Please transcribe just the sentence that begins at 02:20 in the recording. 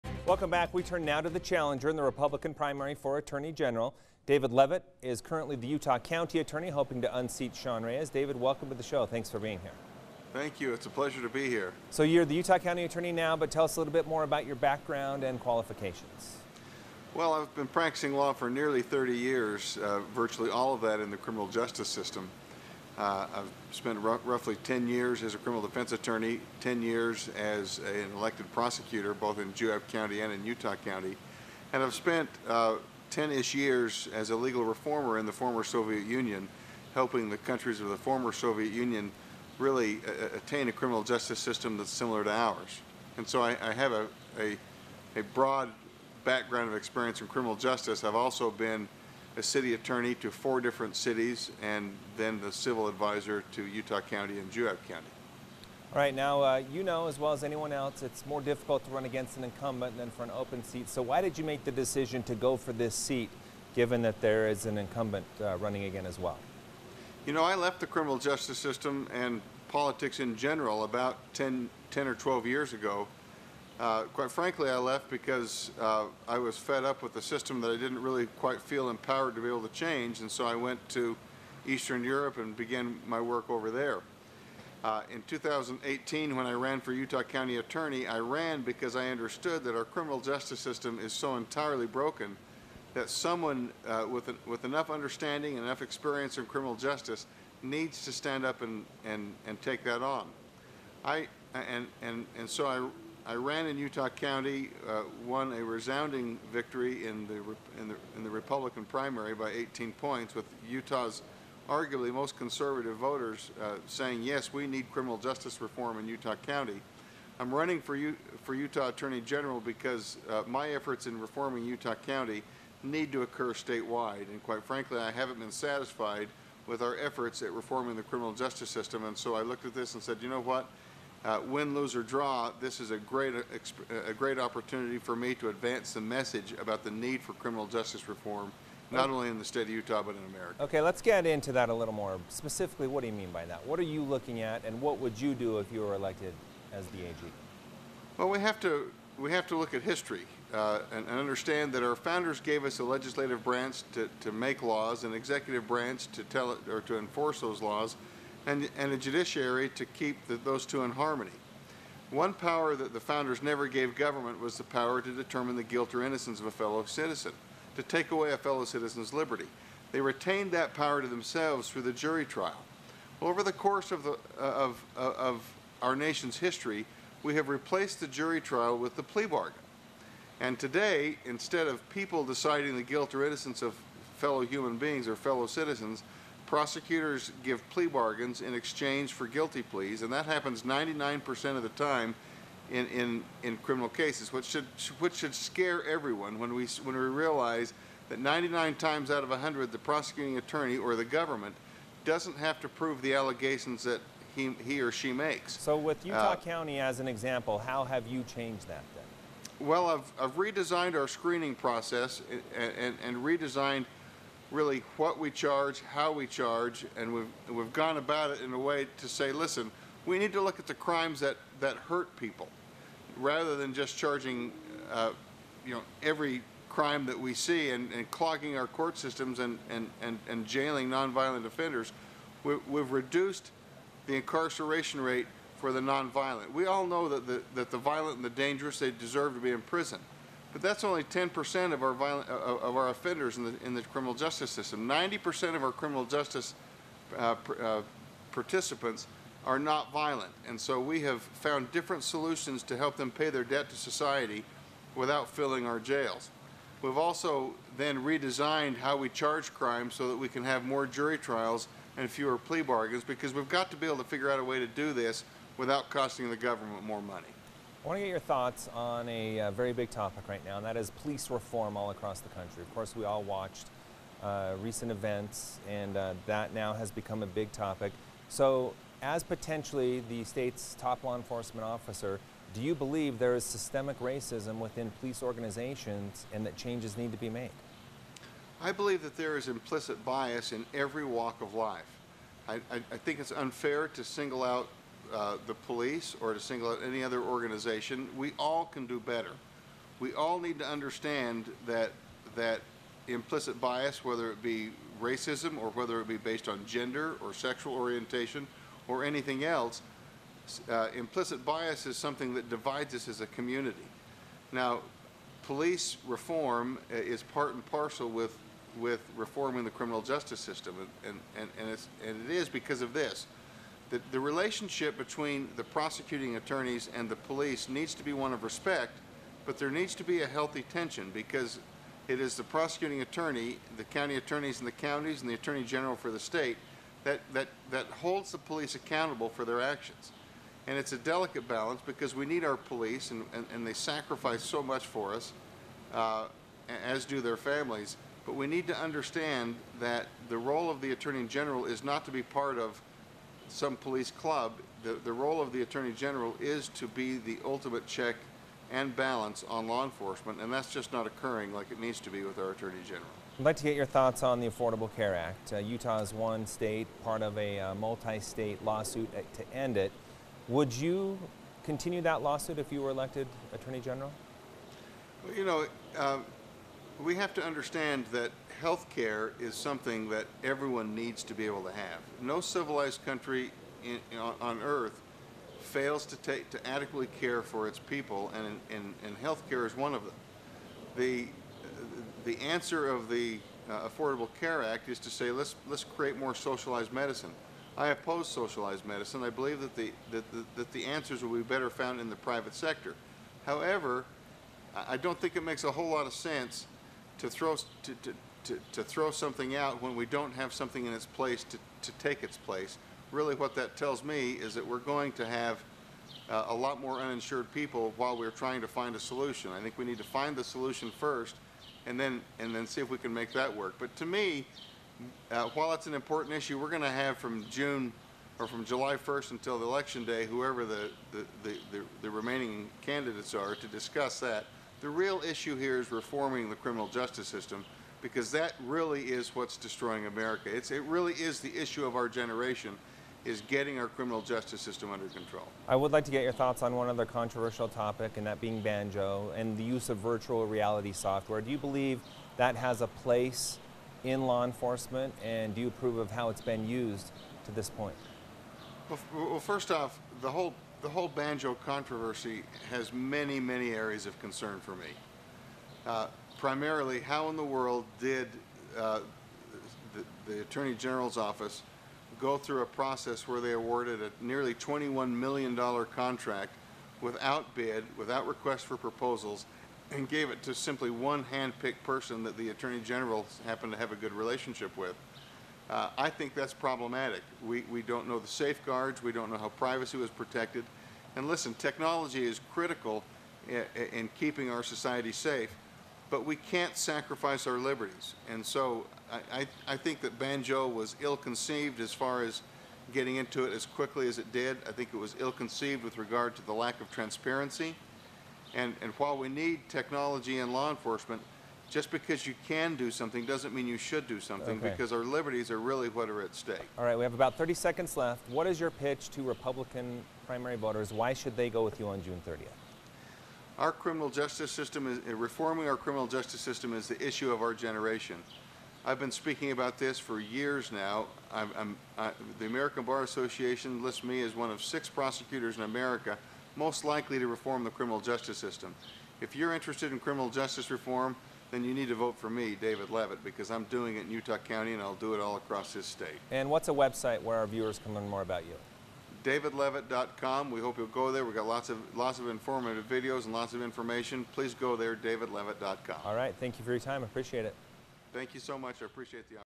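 Okay, let's get into that a little more.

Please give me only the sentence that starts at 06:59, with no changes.
I think we need to find the solution first and then and then see if we can make that work.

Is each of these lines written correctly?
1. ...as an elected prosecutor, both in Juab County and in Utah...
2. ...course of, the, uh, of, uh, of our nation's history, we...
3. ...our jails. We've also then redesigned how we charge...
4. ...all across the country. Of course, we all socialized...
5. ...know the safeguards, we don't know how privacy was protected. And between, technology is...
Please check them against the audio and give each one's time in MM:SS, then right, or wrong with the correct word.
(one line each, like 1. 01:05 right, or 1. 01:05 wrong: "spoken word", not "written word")
1. 00:27 right
2. 02:53 right
3. 04:15 right
4. 04:31 wrong: "watched", not "socialized"
5. 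08:08 wrong: "listen", not "between".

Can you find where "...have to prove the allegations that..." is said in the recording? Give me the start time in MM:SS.
03:22.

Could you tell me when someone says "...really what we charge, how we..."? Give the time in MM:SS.
03:34.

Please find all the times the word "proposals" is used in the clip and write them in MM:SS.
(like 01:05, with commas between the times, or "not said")
07:58.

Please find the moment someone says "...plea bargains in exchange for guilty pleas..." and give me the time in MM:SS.
03:07.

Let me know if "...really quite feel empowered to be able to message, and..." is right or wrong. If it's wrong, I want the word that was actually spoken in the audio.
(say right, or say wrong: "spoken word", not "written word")
wrong: "change", not "message".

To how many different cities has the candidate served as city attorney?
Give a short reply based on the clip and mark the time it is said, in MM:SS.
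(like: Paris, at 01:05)
4, at 00:50.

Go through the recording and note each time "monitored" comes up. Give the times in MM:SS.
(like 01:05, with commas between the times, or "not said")
not said.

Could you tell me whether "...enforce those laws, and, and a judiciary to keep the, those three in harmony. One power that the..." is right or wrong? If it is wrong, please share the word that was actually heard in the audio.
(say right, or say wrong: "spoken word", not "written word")
wrong: "two", not "three".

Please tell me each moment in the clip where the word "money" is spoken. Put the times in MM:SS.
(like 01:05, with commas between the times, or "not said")
04:27.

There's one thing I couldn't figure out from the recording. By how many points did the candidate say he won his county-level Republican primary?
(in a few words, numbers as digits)
18.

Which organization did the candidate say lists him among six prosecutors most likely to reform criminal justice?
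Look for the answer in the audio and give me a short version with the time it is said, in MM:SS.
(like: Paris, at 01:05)
American Bar Association, at 08:52.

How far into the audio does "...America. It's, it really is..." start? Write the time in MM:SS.
07:20.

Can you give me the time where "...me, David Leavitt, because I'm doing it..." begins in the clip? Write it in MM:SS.
09:02.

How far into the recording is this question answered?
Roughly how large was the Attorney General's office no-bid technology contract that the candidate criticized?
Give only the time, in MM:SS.
07:54.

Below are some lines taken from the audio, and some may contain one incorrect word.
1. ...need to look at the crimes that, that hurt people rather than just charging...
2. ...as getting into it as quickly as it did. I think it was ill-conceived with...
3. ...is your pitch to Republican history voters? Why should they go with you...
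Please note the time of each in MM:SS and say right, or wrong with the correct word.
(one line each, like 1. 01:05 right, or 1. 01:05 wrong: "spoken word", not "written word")
1. 03:40 right
2. 08:22 right
3. 08:38 wrong: "primary", not "history".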